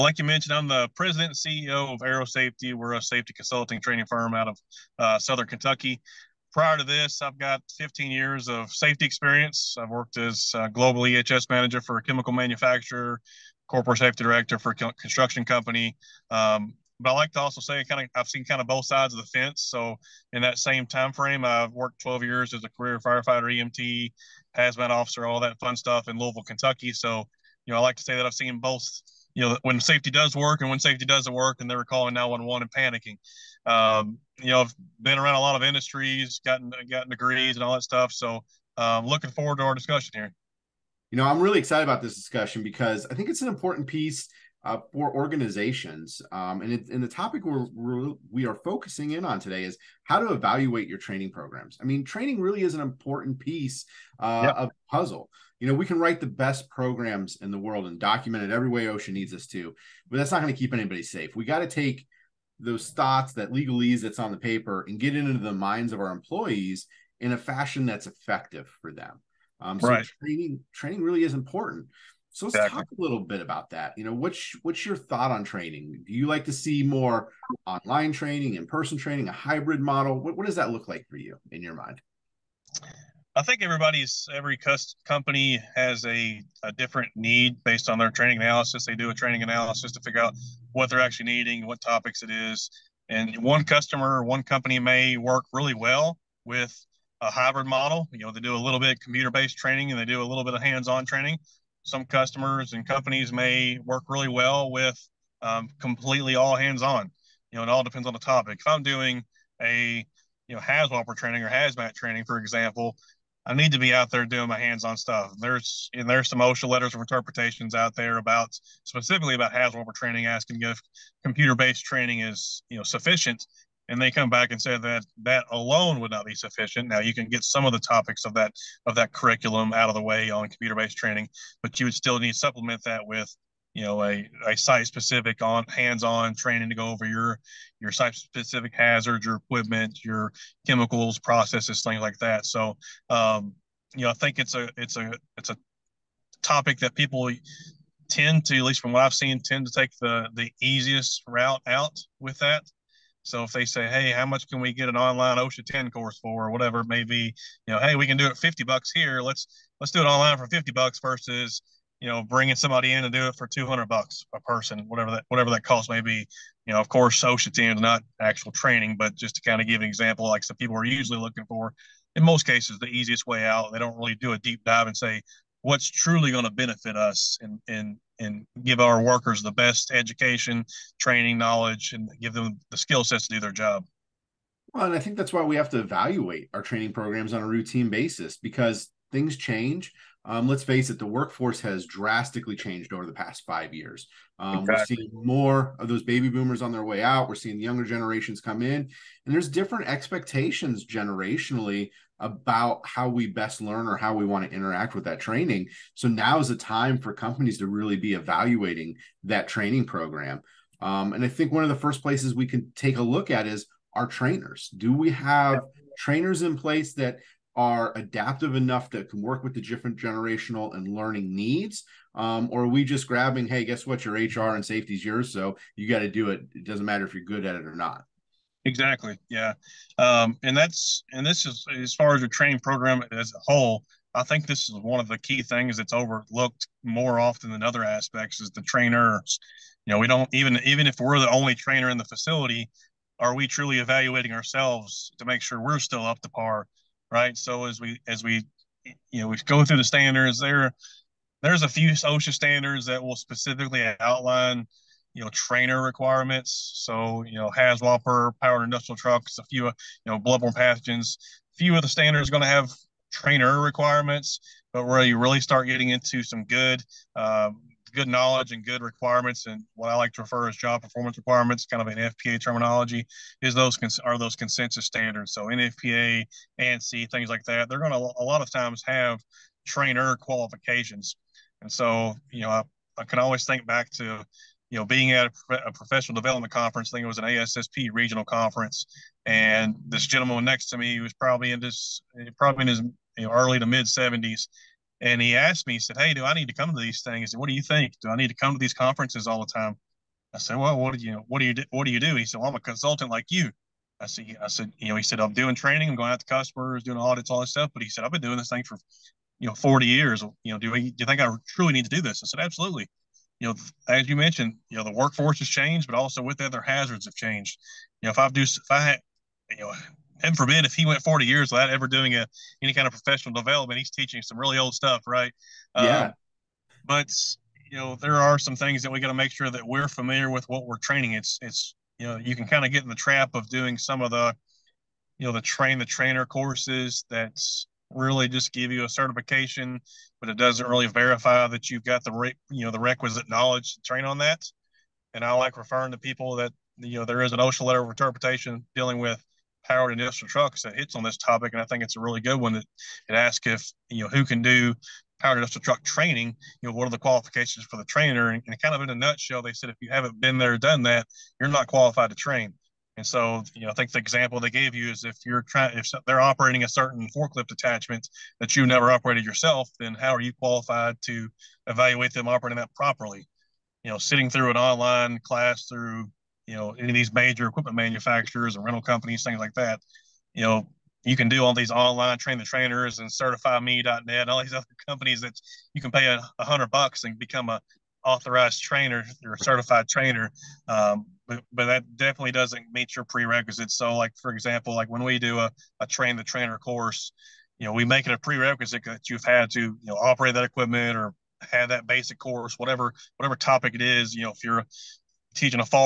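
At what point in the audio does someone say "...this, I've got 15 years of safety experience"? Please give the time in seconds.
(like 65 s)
6 s.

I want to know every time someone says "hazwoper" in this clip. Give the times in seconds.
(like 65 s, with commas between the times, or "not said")
110 s, 119 s, 257 s.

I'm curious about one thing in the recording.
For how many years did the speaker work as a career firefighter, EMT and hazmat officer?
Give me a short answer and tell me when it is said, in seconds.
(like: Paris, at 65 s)
12, at 22 s.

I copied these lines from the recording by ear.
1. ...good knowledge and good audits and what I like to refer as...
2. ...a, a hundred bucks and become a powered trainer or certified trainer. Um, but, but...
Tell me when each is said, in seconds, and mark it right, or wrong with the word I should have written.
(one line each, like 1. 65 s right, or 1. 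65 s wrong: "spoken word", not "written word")
1. 267 s wrong: "requirements", not "audits"
2. 386 s wrong: "authorized", not "powered".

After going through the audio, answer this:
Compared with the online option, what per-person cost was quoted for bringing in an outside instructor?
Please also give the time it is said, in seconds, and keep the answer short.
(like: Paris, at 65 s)
$200, at 163 s.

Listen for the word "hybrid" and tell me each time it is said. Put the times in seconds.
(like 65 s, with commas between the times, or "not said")
79 s, 97 s.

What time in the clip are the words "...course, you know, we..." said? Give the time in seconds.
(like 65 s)
396 s.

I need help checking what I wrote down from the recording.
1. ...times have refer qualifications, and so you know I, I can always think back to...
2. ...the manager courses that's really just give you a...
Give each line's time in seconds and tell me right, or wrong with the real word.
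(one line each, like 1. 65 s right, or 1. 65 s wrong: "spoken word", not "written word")
1. 278 s wrong: "trainer", not "refer"
2. 335 s wrong: "trainer", not "manager".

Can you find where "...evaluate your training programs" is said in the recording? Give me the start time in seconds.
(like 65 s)
50 s.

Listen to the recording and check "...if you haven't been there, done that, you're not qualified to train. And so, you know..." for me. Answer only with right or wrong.
right.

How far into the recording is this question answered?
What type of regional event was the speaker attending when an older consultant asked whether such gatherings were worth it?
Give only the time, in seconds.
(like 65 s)
287 s.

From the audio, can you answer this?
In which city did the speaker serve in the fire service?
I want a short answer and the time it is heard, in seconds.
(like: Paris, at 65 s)
Louisville, Kentucky, at 26 s.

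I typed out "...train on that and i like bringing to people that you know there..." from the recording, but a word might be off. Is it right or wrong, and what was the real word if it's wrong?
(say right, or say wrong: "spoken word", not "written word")
wrong: "referring", not "bringing".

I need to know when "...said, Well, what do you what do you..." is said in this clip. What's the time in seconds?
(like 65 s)
300 s.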